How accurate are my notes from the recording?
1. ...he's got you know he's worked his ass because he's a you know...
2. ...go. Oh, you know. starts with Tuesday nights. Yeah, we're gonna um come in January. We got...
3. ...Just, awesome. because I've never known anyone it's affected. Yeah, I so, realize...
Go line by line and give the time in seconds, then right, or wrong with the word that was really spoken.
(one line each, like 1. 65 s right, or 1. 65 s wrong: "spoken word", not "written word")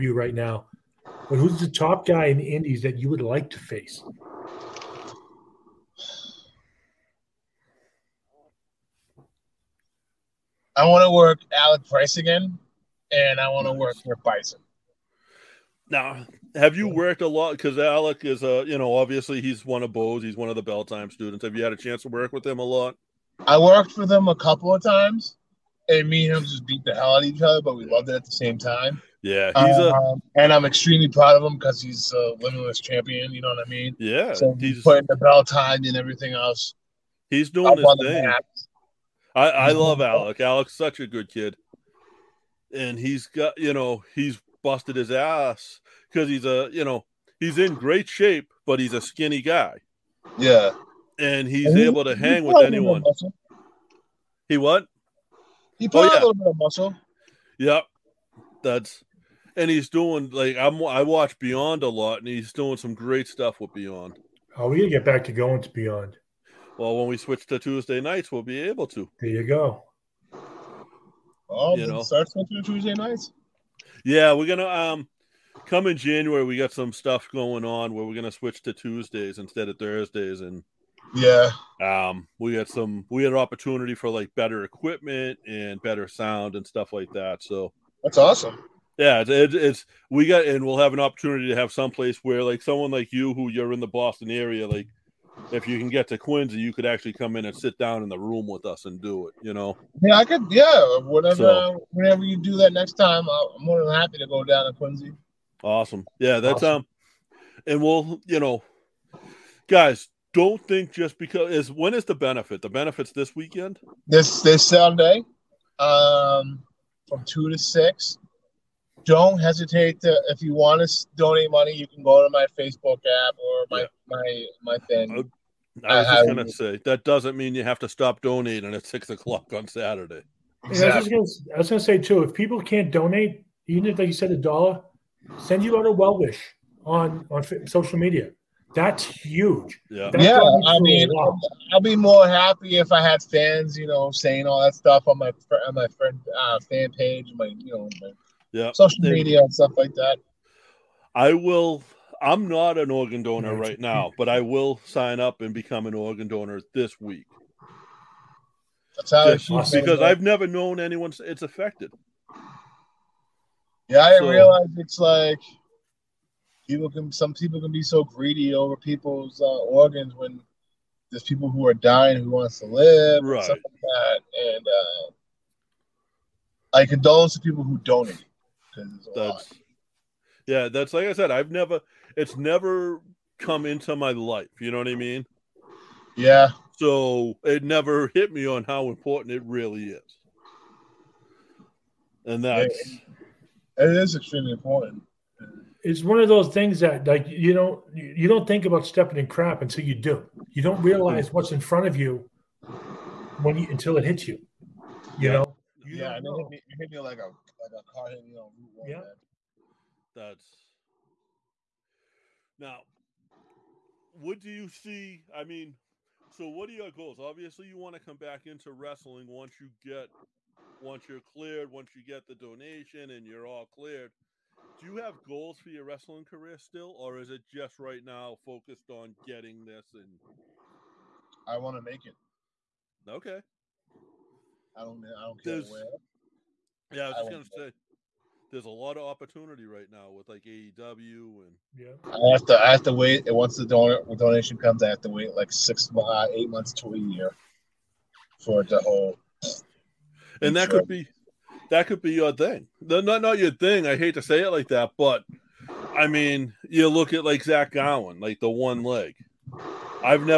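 1. 42 s wrong: "busted", not "worked"
2. 69 s right
3. 159 s right.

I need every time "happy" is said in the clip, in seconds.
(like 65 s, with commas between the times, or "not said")
103 s, 142 s.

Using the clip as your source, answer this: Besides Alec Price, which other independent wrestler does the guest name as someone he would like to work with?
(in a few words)
Bison.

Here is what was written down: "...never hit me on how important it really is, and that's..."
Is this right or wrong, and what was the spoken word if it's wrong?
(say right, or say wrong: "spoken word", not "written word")
right.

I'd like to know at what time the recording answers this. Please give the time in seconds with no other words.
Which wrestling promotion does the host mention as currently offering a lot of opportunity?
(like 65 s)
240 s.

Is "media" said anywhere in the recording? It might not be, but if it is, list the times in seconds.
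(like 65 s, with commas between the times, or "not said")
137 s, 149 s.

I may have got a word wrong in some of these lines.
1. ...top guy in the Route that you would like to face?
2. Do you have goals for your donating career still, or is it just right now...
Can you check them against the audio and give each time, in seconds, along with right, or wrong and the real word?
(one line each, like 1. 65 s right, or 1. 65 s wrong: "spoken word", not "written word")
1. 1 s wrong: "Indies", not "Route"
2. 224 s wrong: "wrestling", not "donating".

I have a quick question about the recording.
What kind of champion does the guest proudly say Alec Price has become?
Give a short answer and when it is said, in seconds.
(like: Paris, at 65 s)
Limitless champion, at 32 s.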